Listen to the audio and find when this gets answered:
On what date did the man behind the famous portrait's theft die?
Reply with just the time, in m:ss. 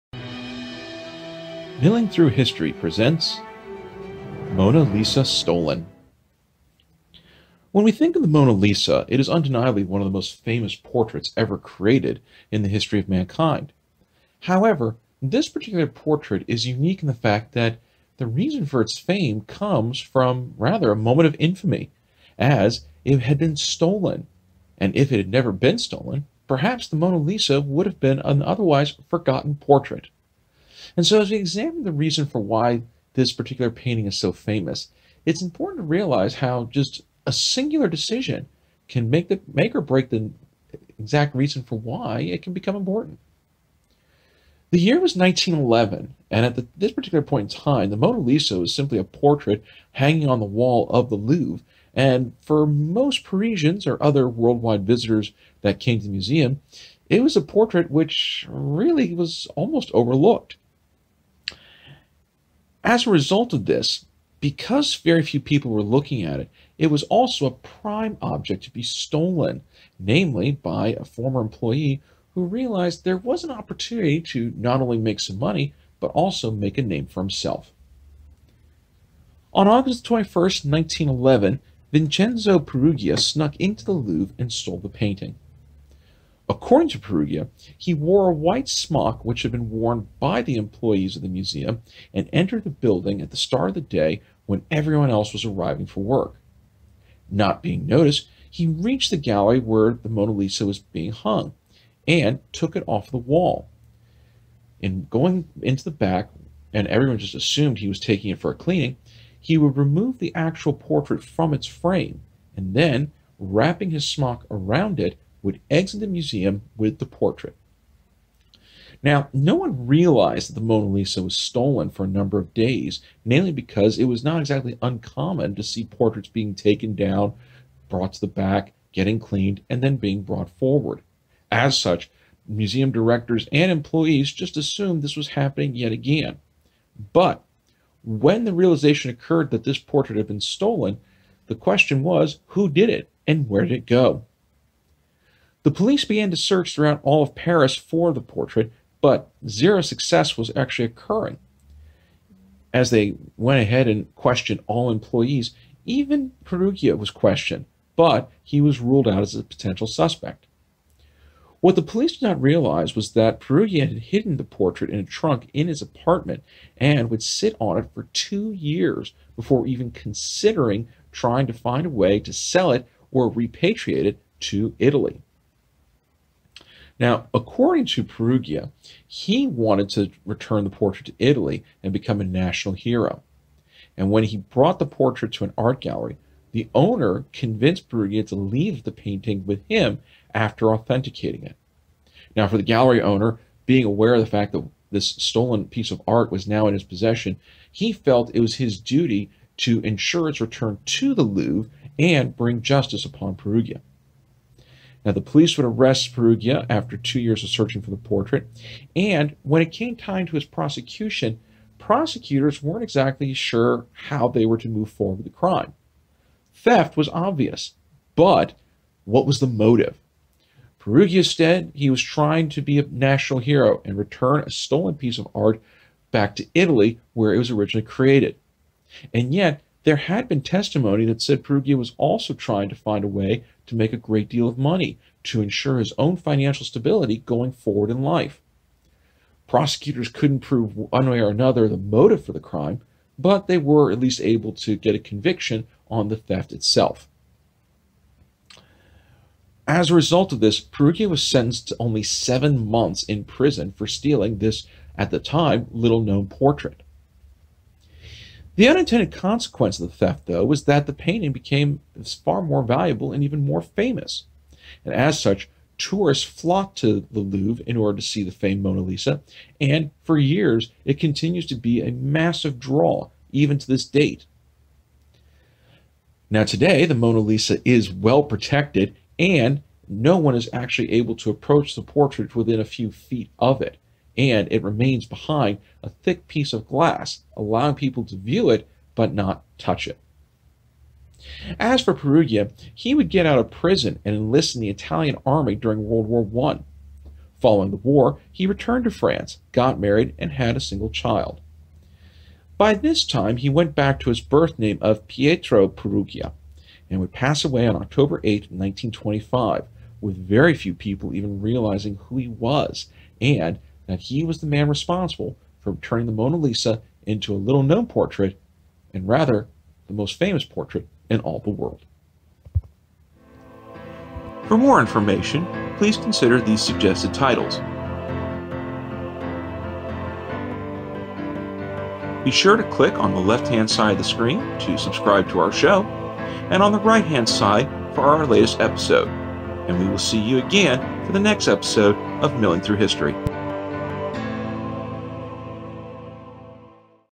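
5:07.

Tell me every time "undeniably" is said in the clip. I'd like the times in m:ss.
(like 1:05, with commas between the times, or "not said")
0:09.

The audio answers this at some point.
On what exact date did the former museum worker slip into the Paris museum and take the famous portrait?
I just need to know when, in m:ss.
1:19.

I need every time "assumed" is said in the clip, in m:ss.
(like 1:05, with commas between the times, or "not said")
1:47, 2:14.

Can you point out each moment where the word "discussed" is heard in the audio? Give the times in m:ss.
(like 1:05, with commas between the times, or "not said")
not said.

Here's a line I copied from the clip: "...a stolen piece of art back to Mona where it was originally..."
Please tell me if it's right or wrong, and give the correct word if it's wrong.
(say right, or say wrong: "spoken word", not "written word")
wrong: "Italy", not "Mona".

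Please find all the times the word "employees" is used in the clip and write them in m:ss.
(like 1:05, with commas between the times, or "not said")
1:11, 1:30, 2:13, 2:34.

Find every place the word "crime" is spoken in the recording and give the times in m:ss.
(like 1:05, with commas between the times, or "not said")
3:35, 4:02.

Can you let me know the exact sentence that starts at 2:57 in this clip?
Now, according to Peruggia, he wanted to return the portrait to Italy and become a national hero.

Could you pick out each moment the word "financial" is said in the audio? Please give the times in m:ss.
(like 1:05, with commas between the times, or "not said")
3:56.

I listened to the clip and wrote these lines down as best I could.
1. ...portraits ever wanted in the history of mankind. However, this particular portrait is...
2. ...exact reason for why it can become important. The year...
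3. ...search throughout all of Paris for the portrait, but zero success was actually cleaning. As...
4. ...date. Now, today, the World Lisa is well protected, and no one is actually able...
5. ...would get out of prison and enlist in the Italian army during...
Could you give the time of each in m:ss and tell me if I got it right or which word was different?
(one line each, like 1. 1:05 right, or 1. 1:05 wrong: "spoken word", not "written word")
1. 0:10 wrong: "created", not "wanted"
2. 0:40 right
3. 2:26 wrong: "occurring", not "cleaning"
4. 4:33 wrong: "Mona", not "World"
5. 4:52 right.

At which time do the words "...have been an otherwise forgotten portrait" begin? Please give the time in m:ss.
0:27.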